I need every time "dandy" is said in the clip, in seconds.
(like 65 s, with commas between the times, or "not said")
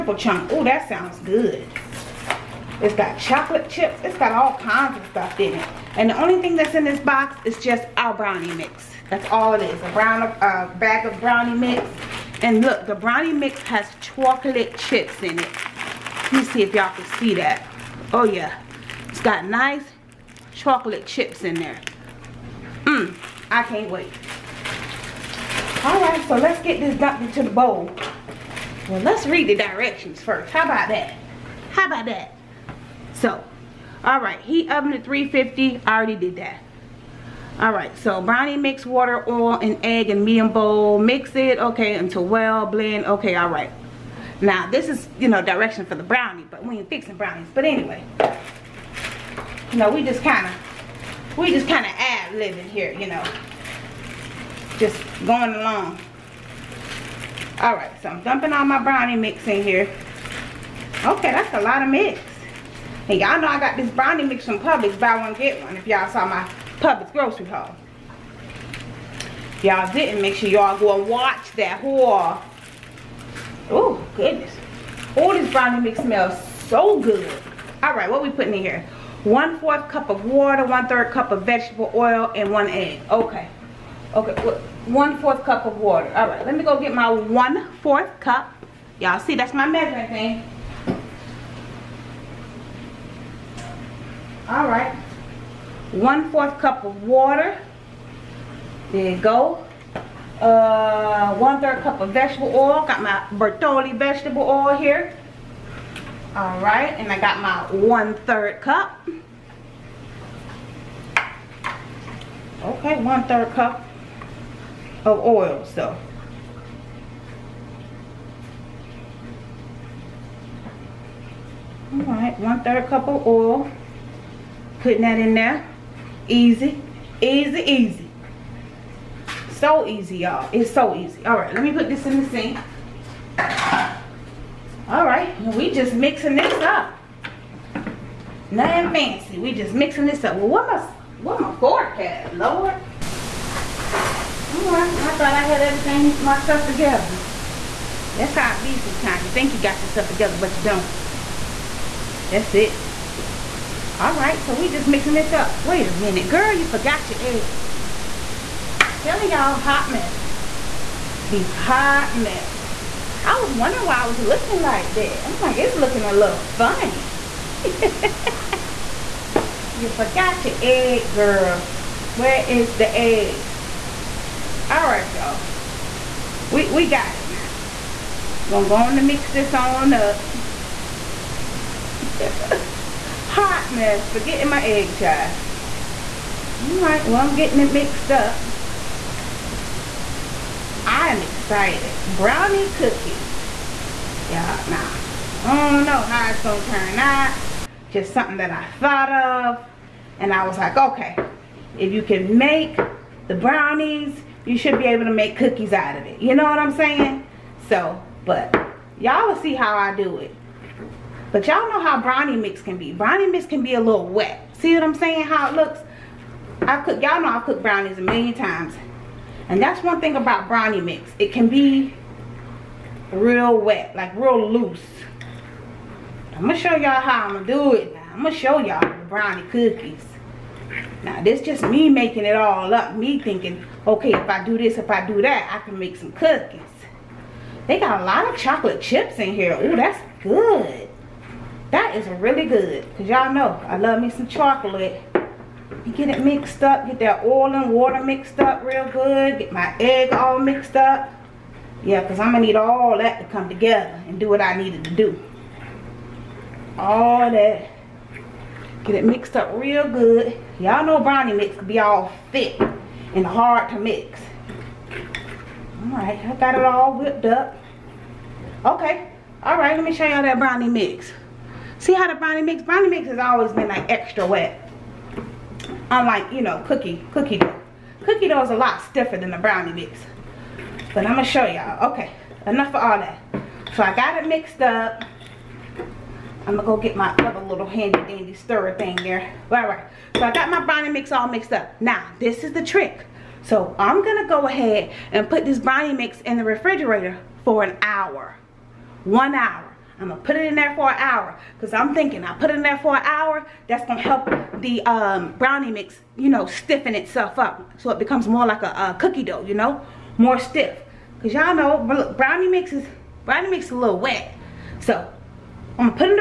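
287 s.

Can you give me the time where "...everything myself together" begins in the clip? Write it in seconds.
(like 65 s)
145 s.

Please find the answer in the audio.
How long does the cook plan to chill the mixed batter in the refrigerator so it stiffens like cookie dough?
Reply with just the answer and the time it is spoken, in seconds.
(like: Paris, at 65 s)
1 hour, at 299 s.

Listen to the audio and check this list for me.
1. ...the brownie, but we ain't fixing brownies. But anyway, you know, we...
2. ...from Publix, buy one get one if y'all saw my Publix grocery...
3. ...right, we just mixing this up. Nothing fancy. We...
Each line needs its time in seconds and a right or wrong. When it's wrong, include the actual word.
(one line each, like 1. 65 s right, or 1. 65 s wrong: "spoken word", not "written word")
1. 45 s right
2. 64 s right
3. 135 s right.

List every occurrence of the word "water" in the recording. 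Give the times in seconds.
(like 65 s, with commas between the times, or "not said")
38 s, 80 s, 85 s, 97 s, 247 s.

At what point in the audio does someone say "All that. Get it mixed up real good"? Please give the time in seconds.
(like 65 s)
256 s.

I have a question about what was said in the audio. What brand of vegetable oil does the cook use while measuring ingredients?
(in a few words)
Bertolli.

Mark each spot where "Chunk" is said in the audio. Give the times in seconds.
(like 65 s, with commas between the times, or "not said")
0 s.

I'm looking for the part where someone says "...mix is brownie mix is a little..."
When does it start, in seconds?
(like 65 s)
312 s.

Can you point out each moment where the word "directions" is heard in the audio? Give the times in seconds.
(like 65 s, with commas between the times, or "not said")
29 s, 45 s.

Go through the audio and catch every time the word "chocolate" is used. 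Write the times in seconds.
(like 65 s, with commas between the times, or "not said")
3 s, 14 s, 20 s, 238 s, 244 s.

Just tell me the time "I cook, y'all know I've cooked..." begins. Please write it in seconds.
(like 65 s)
216 s.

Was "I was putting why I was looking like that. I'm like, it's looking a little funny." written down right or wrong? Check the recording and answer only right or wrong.
wrong.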